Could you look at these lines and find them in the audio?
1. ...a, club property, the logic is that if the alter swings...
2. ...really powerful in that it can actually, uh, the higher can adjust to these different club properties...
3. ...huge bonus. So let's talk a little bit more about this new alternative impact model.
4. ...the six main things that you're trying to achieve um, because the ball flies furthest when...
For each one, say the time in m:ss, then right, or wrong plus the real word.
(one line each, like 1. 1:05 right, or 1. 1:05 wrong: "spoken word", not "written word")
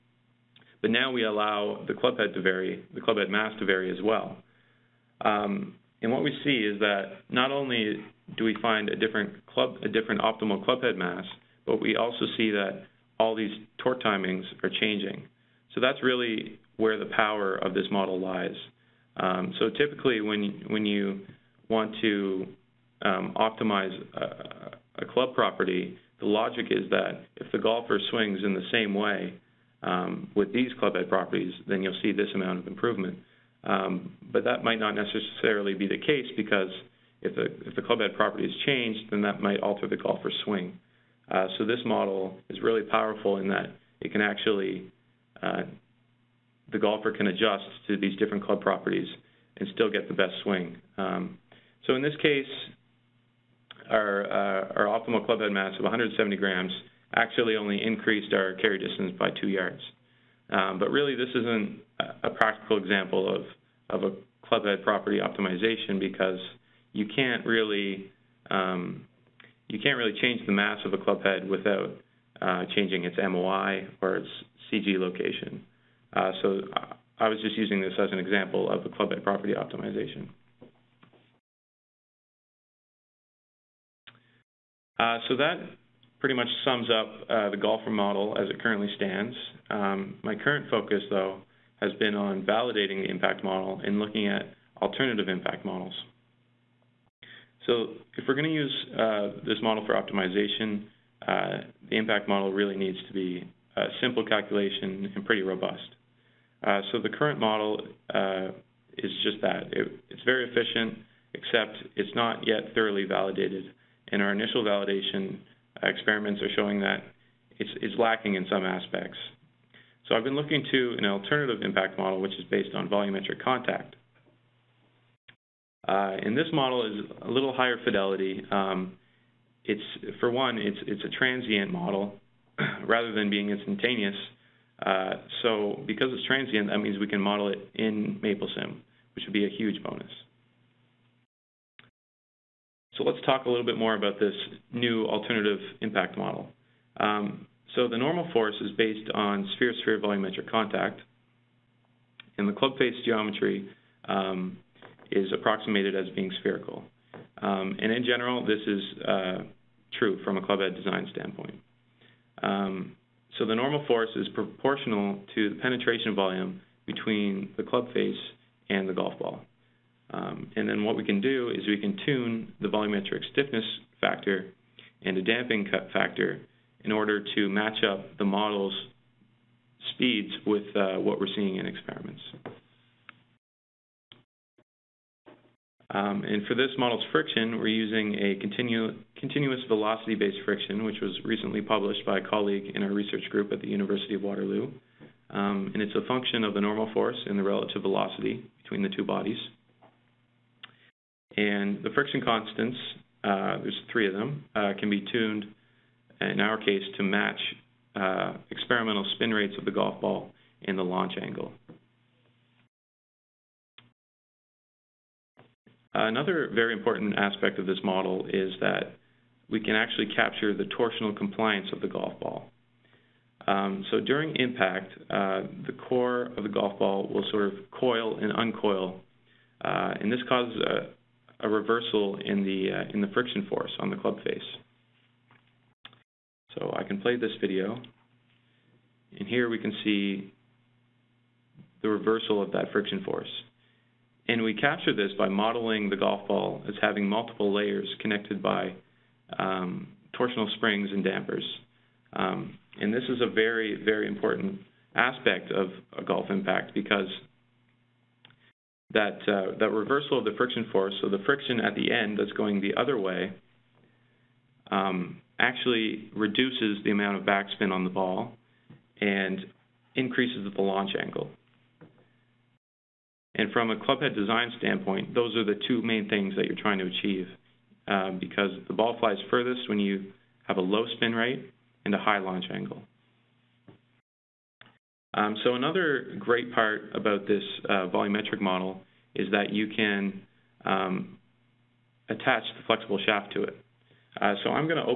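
1. 0:25 wrong: "golfer", not "alter"
2. 0:42 wrong: "golfer", not "higher"
3. 2:19 right
4. 4:35 wrong: "two", not "six".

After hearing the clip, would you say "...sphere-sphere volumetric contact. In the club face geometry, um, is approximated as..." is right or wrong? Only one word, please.
right.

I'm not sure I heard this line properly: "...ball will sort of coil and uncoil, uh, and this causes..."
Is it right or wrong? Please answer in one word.
right.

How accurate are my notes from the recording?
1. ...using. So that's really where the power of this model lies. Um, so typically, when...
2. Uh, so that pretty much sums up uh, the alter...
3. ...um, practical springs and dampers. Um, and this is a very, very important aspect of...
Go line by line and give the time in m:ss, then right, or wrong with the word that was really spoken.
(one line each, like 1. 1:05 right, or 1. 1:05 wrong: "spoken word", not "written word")
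1. 0:14 wrong: "changing", not "using"
2. 1:24 wrong: "golfer", not "alter"
3. 4:09 wrong: "torsional", not "practical".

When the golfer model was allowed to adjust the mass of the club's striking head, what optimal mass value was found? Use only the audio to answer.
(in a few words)
170 grams.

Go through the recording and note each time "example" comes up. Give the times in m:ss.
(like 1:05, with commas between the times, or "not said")
1:02, 1:18.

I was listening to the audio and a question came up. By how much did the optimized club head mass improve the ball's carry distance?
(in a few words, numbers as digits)
2 yards.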